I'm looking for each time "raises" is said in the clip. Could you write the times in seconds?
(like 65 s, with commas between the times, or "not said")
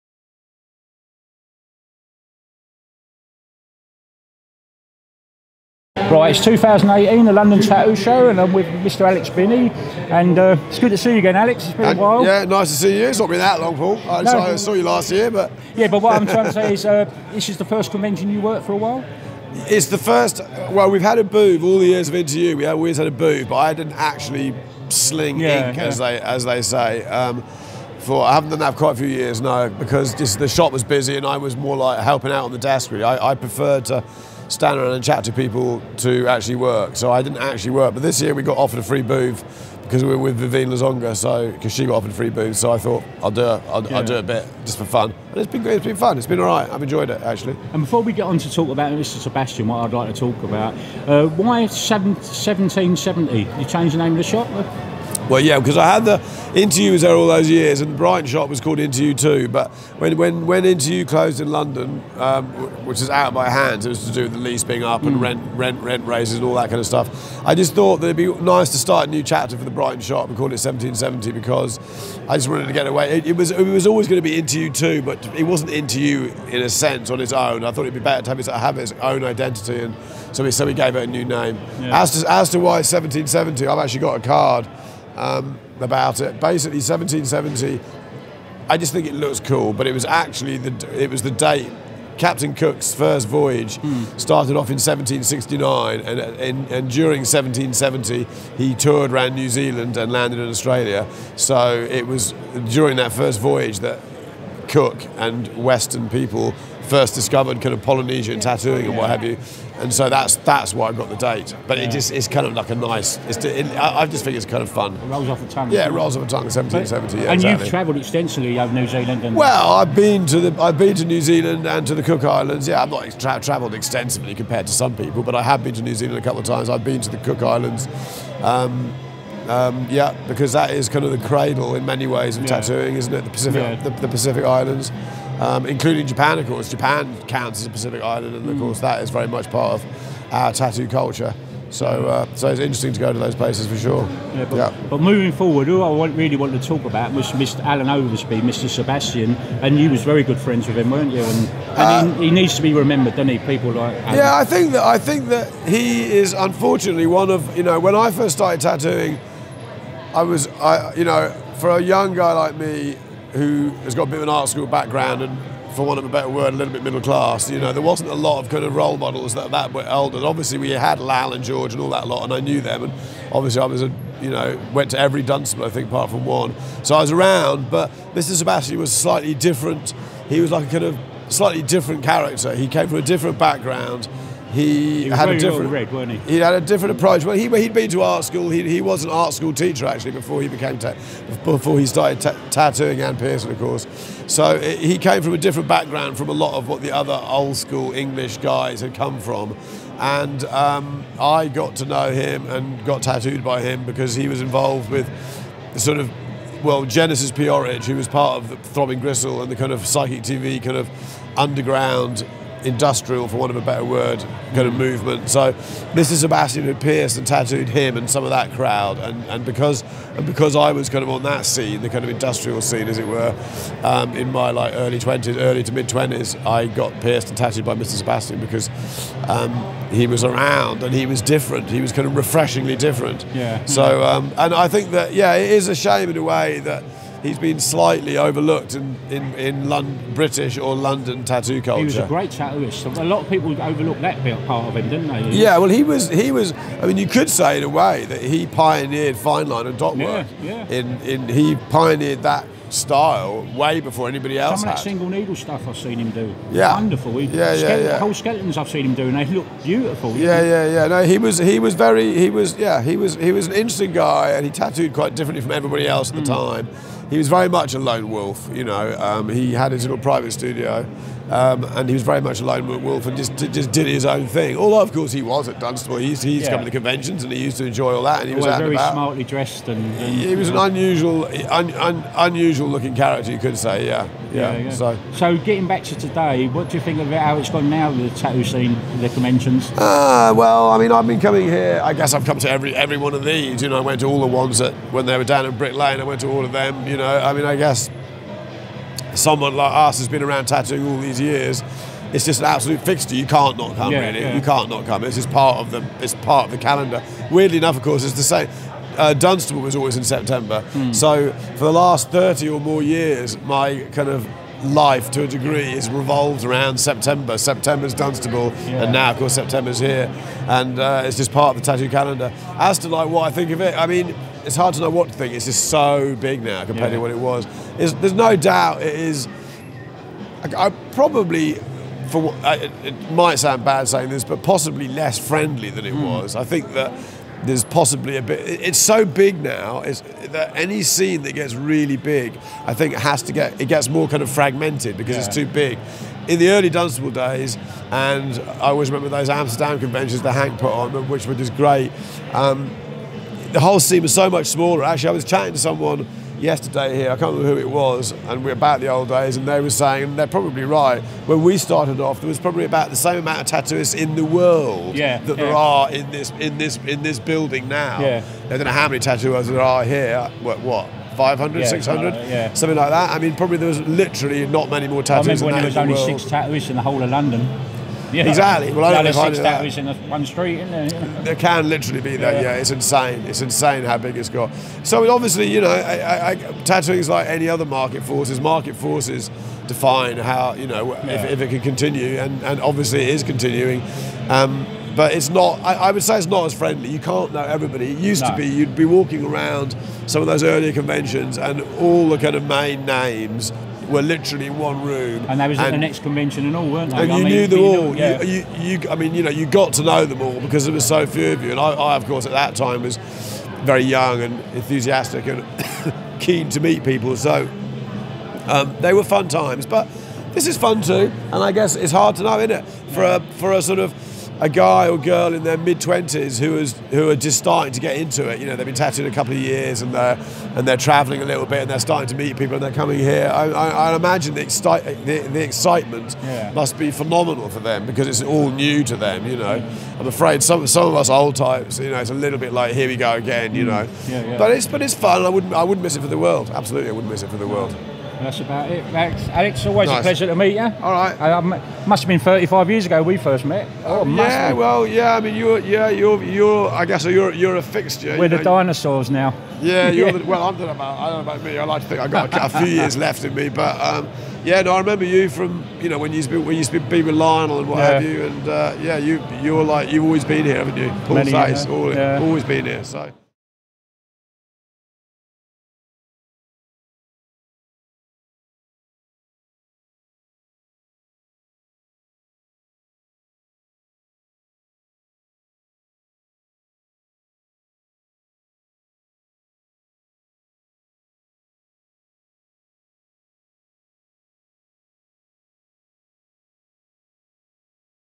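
66 s.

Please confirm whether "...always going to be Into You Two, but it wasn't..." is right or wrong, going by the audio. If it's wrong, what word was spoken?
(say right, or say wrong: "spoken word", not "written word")
right.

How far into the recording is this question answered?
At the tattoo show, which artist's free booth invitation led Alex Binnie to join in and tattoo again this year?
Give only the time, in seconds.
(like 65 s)
40 s.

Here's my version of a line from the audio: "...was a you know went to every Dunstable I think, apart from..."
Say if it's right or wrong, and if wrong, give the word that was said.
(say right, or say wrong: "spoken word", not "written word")
right.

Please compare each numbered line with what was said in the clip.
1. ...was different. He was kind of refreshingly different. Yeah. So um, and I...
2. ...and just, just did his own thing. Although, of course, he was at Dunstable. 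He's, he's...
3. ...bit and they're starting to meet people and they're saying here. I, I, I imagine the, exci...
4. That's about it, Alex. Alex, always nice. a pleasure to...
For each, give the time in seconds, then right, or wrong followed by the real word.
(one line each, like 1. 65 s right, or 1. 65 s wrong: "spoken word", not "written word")
1. 231 s right
2. 273 s right
3. 431 s wrong: "coming", not "saying"
4. 448 s right.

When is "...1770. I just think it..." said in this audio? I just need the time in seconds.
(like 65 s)
86 s.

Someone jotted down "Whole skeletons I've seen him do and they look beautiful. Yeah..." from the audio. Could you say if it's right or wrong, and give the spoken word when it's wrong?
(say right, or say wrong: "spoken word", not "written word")
right.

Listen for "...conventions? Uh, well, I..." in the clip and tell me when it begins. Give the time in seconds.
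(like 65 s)
289 s.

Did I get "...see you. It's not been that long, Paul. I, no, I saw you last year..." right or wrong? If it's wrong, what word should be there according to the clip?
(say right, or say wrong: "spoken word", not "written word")
right.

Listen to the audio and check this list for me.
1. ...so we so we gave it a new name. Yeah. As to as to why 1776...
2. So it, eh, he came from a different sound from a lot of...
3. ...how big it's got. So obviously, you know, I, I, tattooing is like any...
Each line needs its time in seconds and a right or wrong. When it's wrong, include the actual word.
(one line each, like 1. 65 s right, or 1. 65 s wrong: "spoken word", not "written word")
1. 80 s wrong: "1770", not "1776"
2. 194 s wrong: "background", not "sound"
3. 383 s right.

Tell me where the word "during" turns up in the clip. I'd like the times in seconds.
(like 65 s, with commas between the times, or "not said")
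96 s, 102 s.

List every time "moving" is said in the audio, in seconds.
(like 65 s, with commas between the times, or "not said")
144 s.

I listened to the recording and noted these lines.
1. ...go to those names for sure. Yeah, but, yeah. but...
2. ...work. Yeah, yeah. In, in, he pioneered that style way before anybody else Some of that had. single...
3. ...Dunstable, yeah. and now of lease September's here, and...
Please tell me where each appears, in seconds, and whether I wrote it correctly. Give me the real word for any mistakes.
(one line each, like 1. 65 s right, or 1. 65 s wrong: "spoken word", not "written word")
1. 142 s wrong: "places", not "names"
2. 249 s right
3. 317 s wrong: "course", not "lease".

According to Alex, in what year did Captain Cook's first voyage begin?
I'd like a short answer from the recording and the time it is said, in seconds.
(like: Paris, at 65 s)
1769, at 94 s.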